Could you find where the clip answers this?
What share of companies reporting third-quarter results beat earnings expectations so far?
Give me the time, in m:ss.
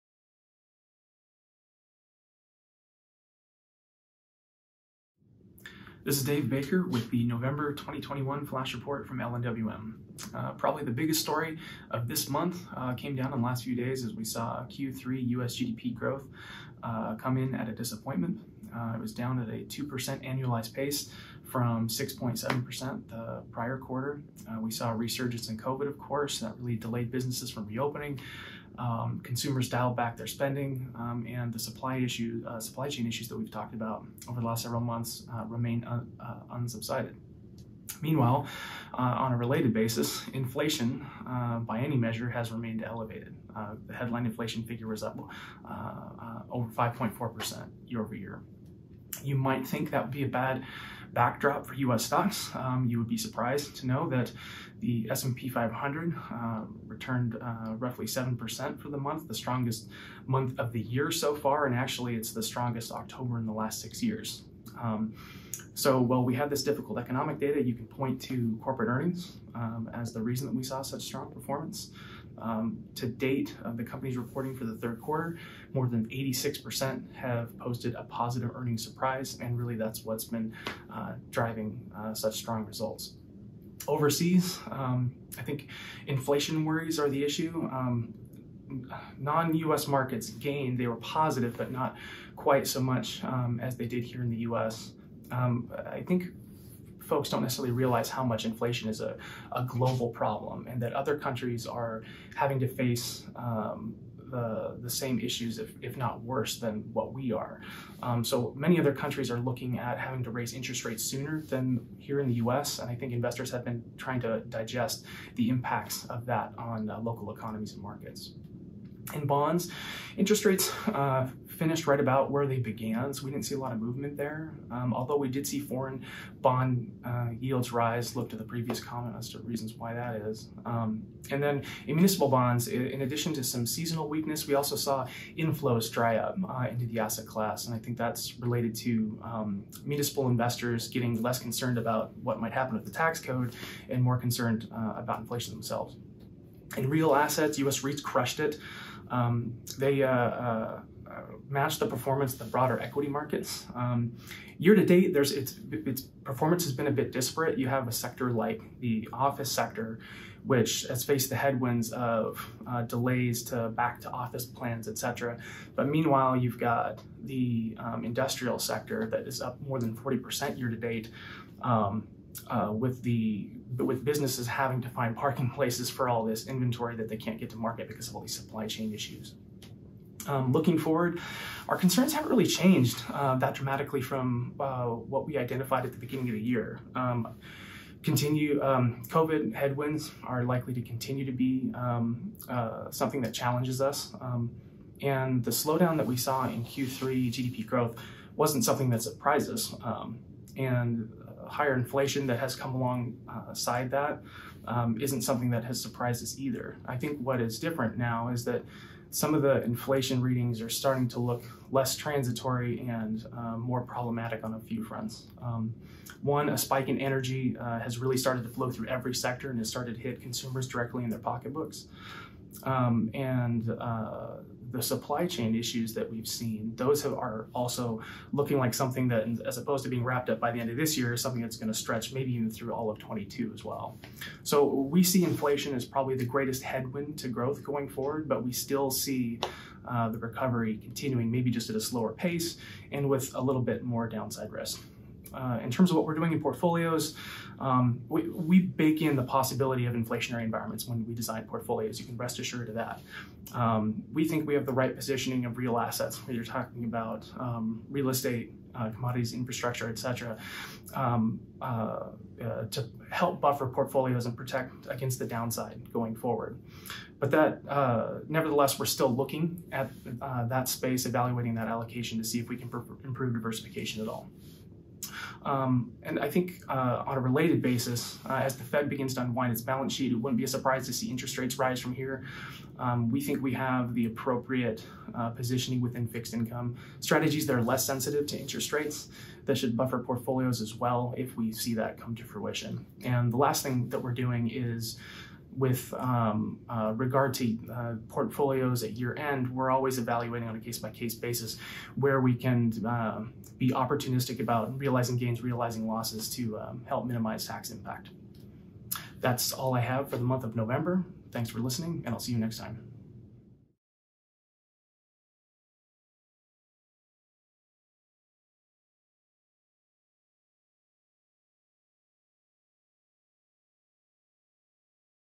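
1:15.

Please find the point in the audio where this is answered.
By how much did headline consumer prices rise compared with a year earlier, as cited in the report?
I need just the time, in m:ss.
0:46.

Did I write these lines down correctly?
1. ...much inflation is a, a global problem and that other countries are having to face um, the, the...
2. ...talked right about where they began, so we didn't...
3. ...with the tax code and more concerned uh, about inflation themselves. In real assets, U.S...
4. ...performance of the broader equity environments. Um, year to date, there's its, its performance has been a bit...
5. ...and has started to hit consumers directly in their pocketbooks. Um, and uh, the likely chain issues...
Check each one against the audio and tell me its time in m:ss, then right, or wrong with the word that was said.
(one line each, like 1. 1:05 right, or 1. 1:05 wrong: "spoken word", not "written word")
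1. 1:38 right
2. 2:01 wrong: "finished", not "talked"
3. 2:22 right
4. 2:31 wrong: "markets", not "environments"
5. 3:39 wrong: "supply", not "likely".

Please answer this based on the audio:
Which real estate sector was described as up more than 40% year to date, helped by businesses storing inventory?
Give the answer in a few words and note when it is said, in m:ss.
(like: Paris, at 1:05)
industrial sector, at 2:48.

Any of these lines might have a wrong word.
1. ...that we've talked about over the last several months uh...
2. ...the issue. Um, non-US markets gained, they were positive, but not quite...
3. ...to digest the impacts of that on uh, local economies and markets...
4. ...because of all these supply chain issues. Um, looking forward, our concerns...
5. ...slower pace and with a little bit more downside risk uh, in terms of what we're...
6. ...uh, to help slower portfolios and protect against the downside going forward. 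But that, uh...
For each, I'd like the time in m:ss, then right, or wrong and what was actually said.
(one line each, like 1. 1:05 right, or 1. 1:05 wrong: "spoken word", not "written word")
1. 0:33 right
2. 1:27 right
3. 1:54 right
4. 2:57 right
5. 4:01 right
6. 4:22 wrong: "buffer", not "slower".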